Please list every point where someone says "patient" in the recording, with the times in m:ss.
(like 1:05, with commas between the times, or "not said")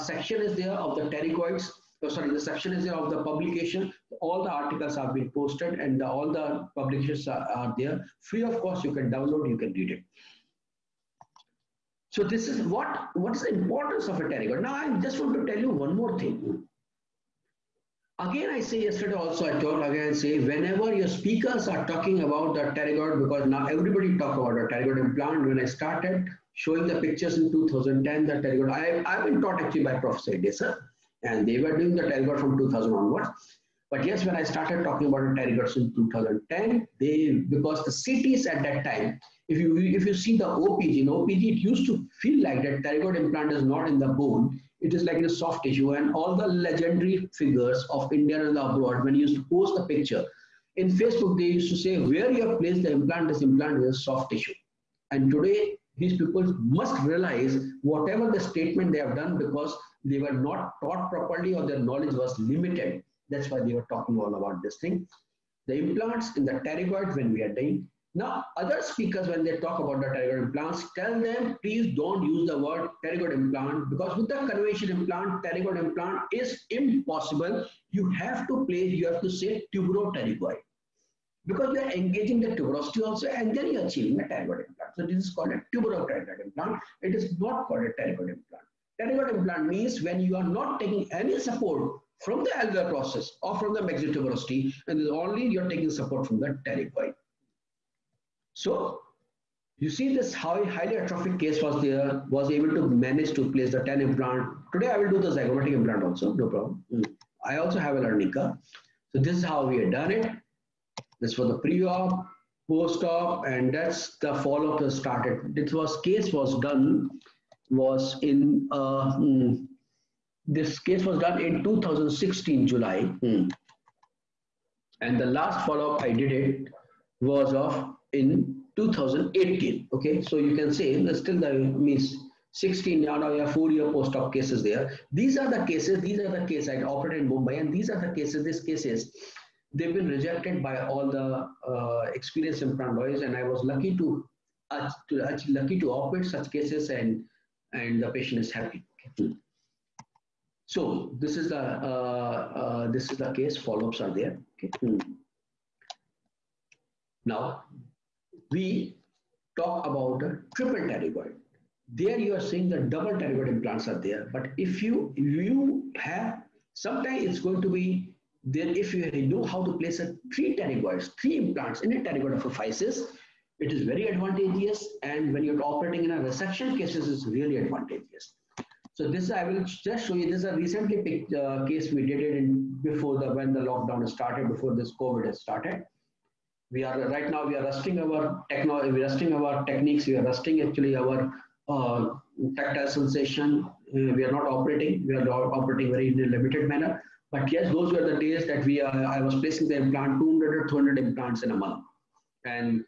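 2:28.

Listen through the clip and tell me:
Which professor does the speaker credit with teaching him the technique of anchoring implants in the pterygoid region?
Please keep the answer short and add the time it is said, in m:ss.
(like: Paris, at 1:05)
Professor Edesa, at 0:29.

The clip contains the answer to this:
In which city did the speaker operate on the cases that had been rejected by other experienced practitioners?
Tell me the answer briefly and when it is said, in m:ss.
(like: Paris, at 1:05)
Mumbai, at 2:17.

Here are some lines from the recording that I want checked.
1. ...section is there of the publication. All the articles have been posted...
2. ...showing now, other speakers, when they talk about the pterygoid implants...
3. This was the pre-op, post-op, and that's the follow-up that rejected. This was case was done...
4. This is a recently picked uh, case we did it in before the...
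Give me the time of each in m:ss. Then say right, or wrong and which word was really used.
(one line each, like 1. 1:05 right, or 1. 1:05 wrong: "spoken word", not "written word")
1. 0:02 right
2. 1:07 wrong: "dying", not "showing"
3. 1:51 wrong: "started", not "rejected"
4. 3:00 right.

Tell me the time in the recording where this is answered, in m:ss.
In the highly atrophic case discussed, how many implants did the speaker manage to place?
1:43.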